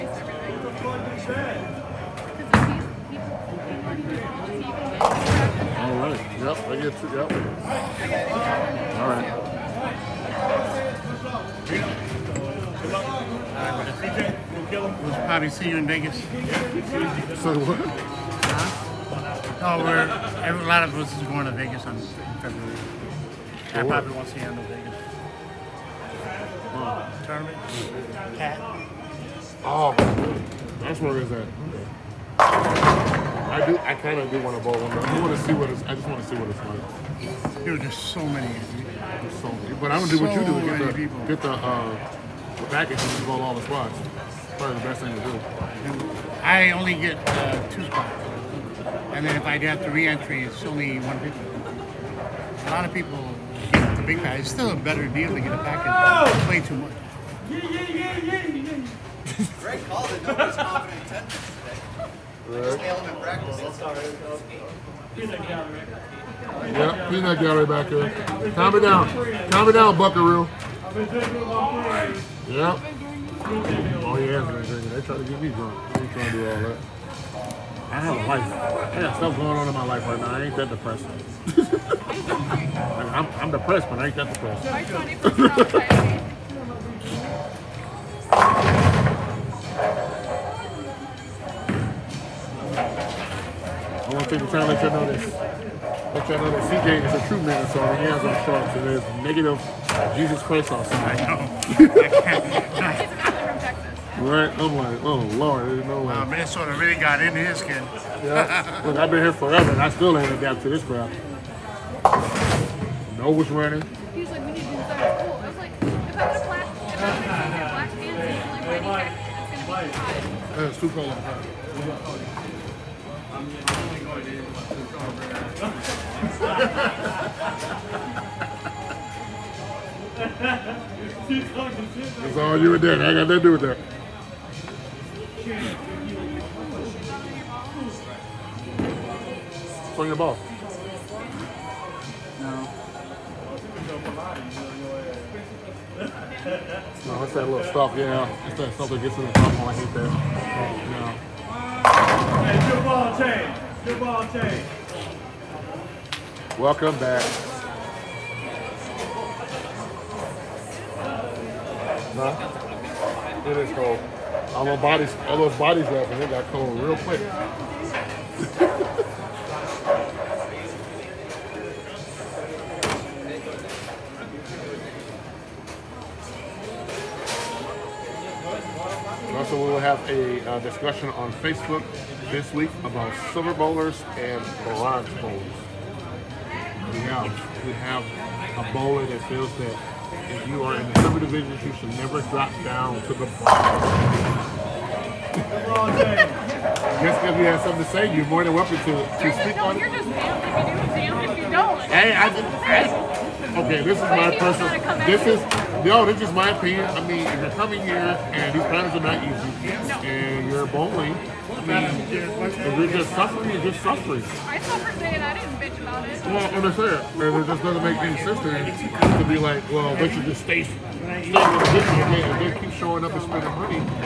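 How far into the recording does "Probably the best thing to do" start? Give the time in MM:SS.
00:44.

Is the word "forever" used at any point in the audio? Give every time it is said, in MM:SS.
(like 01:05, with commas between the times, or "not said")
01:49.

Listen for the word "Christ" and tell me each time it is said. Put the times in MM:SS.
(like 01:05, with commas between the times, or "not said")
01:40.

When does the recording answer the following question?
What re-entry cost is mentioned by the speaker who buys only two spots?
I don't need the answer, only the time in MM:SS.
00:51.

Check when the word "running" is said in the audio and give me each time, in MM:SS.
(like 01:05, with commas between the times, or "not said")
01:53.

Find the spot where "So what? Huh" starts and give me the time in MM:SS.
00:16.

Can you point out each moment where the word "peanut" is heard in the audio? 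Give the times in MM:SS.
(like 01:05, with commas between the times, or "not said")
01:07.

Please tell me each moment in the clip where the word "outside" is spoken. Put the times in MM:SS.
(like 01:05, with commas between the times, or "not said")
01:40.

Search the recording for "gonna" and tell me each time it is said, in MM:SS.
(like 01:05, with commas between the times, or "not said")
00:40, 02:00.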